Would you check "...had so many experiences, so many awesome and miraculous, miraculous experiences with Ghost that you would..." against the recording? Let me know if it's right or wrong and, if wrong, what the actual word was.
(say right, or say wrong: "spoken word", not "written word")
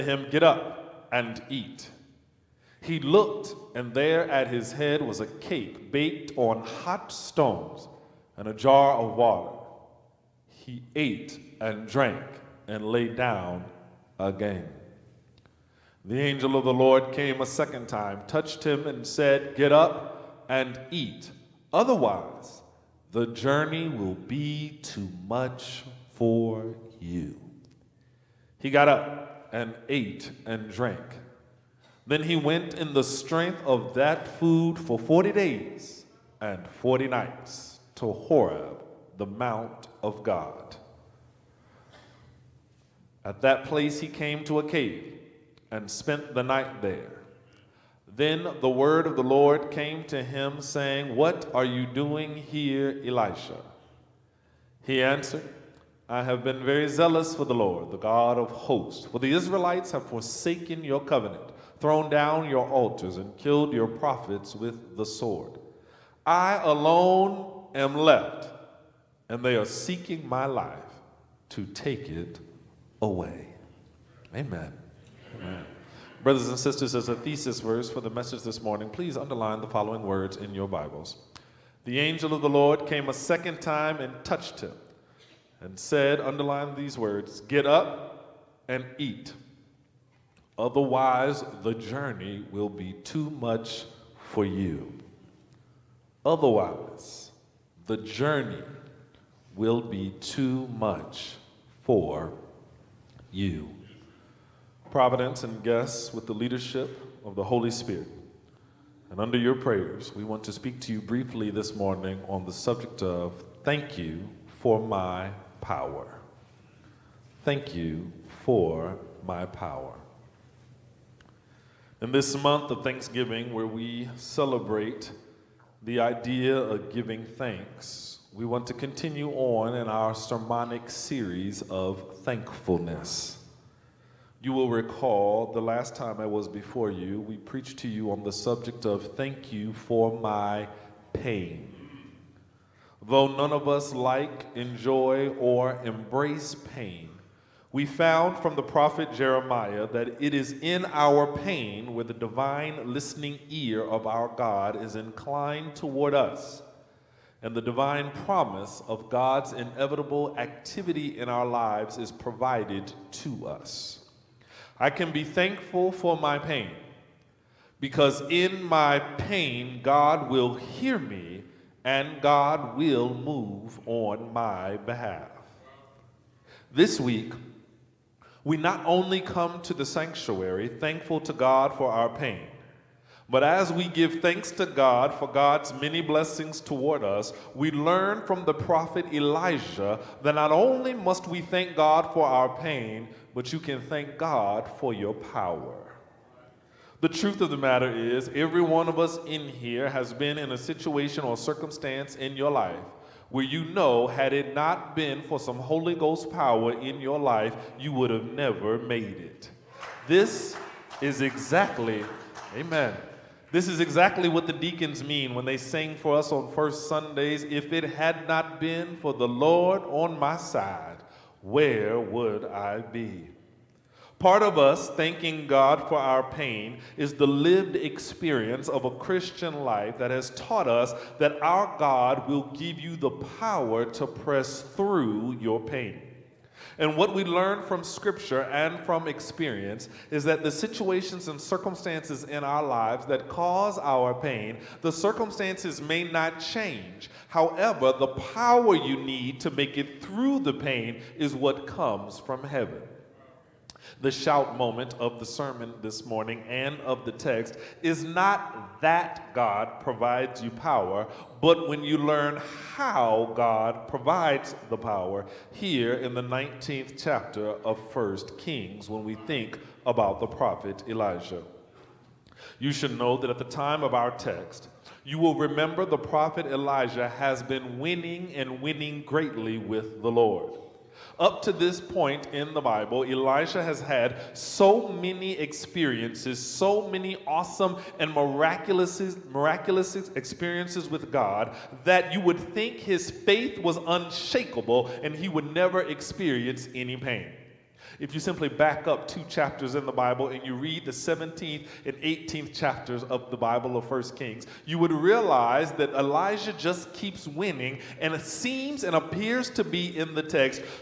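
wrong: "God", not "Ghost".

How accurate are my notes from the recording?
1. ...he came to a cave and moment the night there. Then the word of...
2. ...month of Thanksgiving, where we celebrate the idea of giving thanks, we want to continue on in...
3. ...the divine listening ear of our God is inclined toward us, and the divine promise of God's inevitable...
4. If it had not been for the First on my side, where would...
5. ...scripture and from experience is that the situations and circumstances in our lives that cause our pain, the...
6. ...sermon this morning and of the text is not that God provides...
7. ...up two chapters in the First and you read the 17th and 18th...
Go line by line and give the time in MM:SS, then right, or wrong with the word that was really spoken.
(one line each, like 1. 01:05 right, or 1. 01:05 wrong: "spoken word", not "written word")
1. 00:44 wrong: "spent", not "moment"
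2. 02:02 right
3. 02:32 right
4. 03:37 wrong: "Lord", not "First"
5. 03:57 right
6. 04:15 right
7. 04:58 wrong: "Bible", not "First".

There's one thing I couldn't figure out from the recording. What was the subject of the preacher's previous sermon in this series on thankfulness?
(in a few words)
Thank you for my pain.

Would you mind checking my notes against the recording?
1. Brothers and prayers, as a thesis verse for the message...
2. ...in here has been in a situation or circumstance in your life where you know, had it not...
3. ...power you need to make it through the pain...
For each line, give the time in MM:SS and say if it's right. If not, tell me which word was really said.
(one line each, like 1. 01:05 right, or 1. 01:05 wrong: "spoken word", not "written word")
1. 01:16 wrong: "sisters", not "prayers"
2. 03:19 right
3. 04:08 right.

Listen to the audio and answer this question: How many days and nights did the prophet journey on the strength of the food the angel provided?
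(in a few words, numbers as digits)
40.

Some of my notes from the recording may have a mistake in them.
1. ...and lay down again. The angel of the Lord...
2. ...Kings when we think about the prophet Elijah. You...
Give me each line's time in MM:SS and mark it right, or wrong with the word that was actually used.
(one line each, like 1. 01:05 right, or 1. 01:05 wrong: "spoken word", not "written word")
1. 00:12 right
2. 04:28 right.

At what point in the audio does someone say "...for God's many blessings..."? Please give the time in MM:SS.
03:05.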